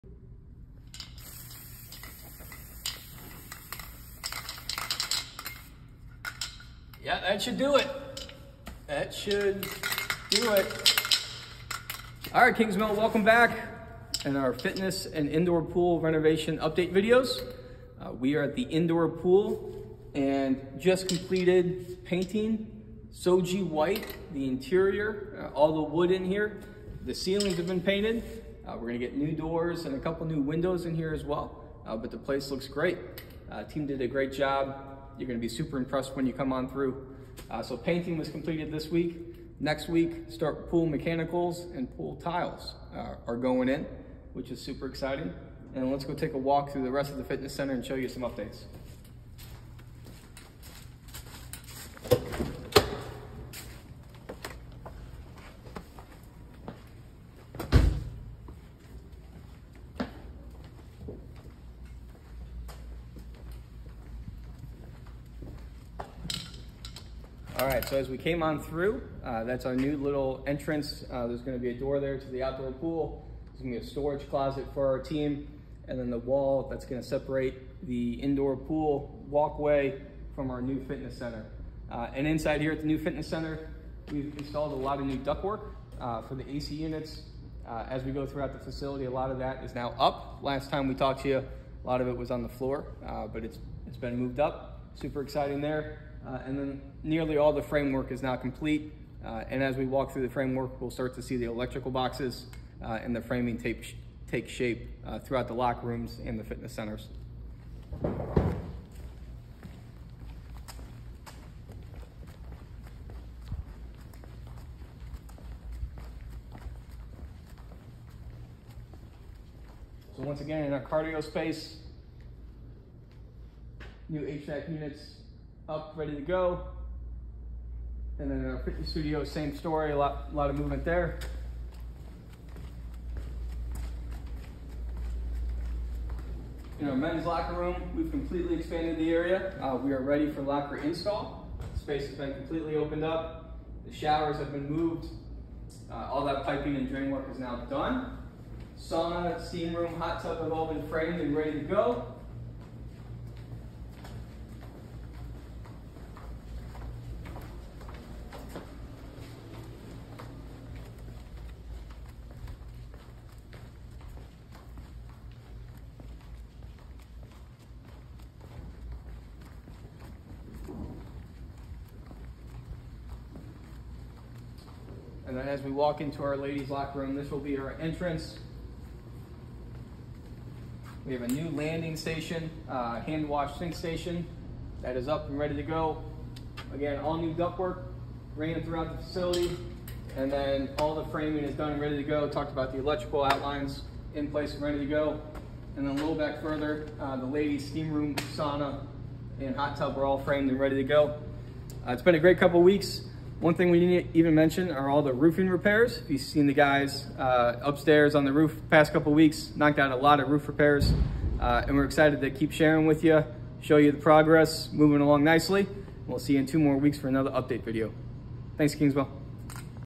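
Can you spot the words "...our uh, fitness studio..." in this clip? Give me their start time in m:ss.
2:08.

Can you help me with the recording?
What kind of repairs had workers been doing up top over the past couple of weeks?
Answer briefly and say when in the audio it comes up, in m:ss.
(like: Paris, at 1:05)
Roofing repairs, at 3:25.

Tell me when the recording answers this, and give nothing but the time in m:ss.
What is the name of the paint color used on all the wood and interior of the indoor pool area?
0:23.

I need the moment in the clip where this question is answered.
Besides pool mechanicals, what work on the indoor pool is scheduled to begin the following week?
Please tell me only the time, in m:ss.
0:41.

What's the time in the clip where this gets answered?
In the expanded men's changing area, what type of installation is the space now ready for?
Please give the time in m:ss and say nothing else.
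2:20.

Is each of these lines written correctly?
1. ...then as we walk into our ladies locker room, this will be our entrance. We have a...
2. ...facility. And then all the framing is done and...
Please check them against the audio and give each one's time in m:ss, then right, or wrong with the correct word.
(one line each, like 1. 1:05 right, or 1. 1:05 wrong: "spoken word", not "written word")
1. 2:55 right
2. 3:09 right.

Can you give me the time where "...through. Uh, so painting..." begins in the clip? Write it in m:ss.
0:36.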